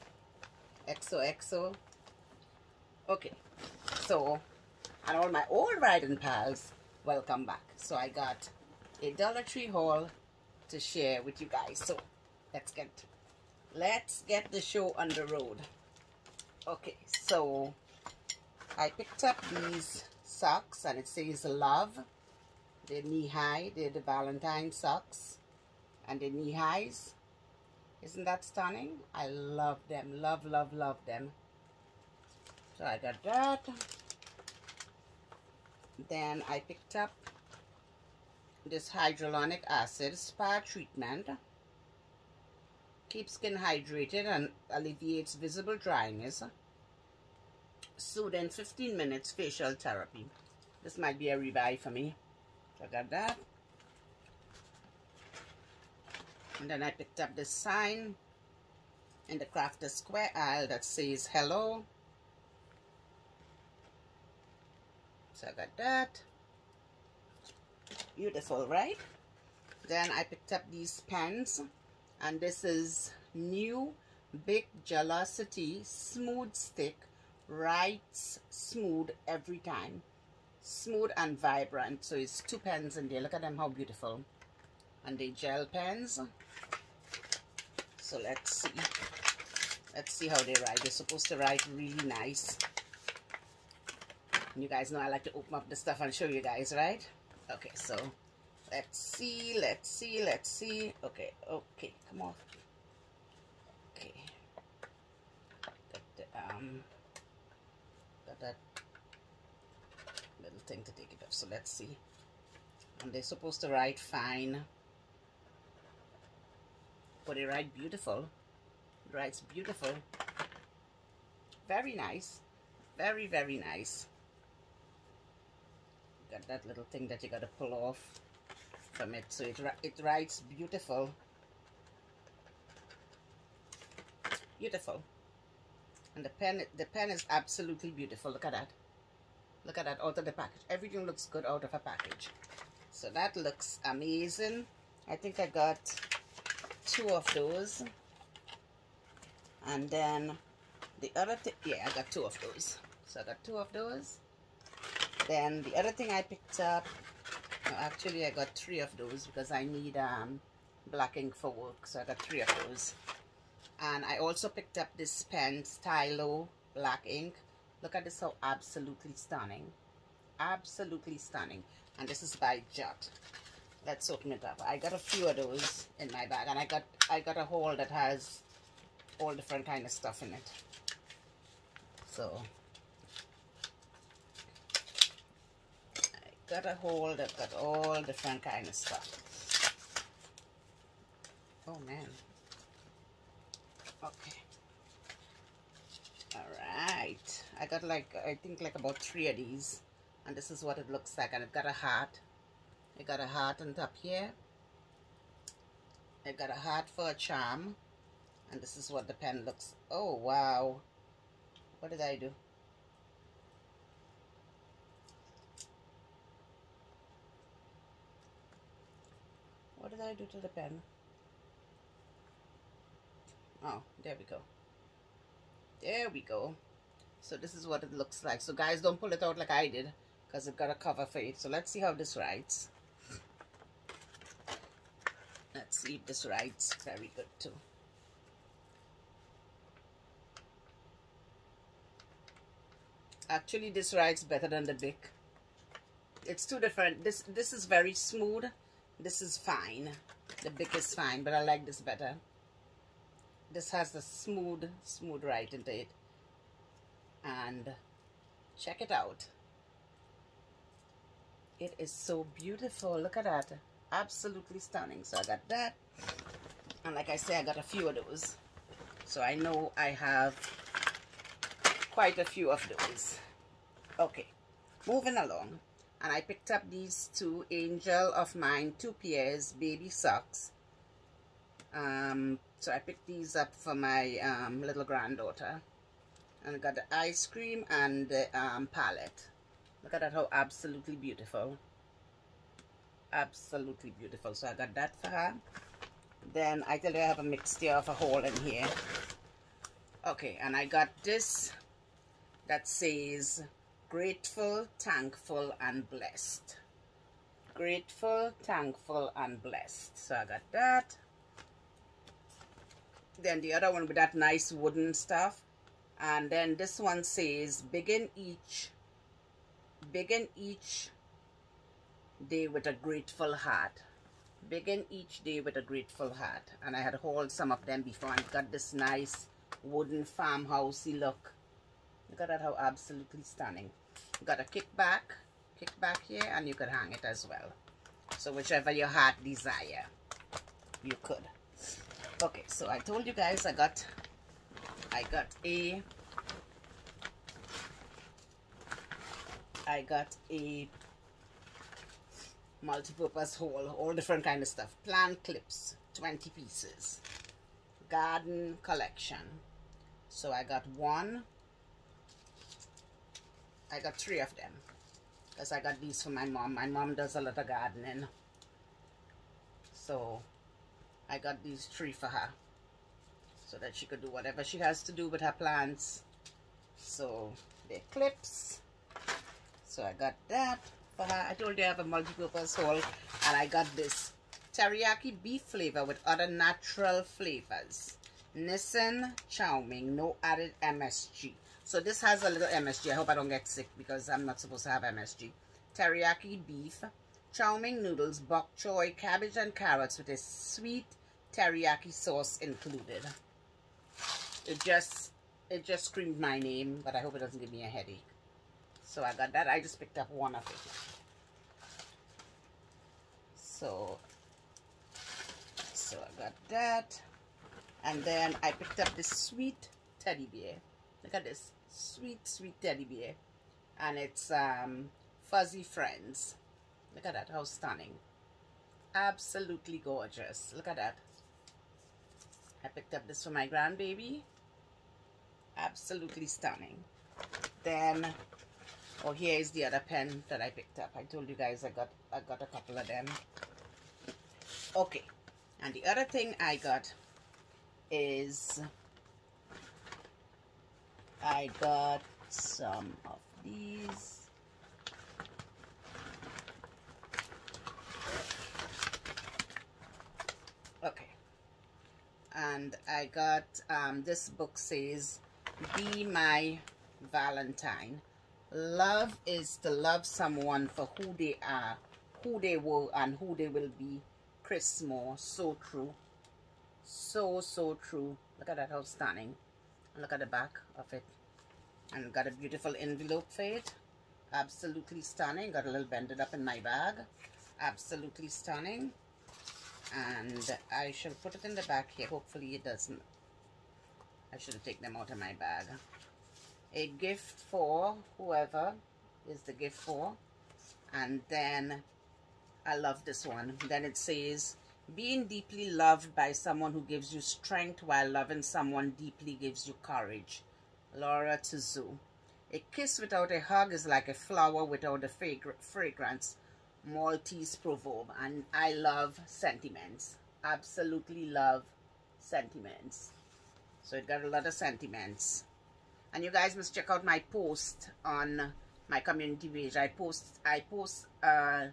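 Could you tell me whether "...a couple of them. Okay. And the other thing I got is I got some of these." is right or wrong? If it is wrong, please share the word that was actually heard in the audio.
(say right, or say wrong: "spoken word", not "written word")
right.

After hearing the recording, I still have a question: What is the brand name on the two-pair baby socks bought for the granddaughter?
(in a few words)
Angel of Mine.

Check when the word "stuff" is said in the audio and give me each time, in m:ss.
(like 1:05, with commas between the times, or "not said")
1:35, 2:59, 3:08, 5:14, 5:54.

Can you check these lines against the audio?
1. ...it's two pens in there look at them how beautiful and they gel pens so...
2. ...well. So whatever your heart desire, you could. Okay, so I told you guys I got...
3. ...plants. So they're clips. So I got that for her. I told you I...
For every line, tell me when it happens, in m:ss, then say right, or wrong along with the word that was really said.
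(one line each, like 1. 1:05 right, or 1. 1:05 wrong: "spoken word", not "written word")
1. 1:22 right
2. 5:37 wrong: "whichever", not "whatever"
3. 6:15 right.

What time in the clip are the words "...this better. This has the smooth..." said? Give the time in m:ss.
4:11.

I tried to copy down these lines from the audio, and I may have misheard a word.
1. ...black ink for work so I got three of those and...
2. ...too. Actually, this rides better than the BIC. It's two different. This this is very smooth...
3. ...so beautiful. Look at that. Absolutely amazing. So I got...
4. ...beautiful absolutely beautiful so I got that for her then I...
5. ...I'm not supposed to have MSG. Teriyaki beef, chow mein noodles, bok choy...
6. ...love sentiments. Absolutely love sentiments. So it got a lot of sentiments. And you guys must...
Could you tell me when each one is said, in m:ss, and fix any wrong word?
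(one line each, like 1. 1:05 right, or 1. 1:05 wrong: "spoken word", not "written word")
1. 2:40 right
2. 3:57 right
3. 4:21 wrong: "stunning", not "amazing"
4. 4:50 right
5. 6:34 right
6. 8:38 right.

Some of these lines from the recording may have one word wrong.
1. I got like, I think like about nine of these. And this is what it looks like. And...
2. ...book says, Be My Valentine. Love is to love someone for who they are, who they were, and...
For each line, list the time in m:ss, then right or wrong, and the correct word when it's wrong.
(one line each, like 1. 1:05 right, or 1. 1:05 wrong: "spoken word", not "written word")
1. 3:17 wrong: "three", not "nine"
2. 7:44 right.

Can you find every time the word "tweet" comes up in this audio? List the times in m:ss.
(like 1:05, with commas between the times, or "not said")
not said.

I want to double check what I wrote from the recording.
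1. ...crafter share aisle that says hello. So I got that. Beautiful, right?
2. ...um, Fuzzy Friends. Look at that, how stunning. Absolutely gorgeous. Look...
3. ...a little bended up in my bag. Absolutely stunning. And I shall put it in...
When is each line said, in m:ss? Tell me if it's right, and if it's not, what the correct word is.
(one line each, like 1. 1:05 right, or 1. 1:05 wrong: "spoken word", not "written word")
1. 0:59 wrong: "square", not "share"
2. 7:04 right
3. 8:05 right.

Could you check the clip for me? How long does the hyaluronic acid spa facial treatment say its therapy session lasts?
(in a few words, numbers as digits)
15 minutes.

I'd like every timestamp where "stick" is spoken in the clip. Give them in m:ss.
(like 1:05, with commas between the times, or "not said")
1:16.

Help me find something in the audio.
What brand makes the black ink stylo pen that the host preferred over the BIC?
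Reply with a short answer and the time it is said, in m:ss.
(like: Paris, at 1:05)
Jot, at 2:52.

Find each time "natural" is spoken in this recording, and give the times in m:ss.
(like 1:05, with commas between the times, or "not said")
6:26.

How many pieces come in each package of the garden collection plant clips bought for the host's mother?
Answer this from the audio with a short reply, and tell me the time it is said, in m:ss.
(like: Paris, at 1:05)
20, at 5:55.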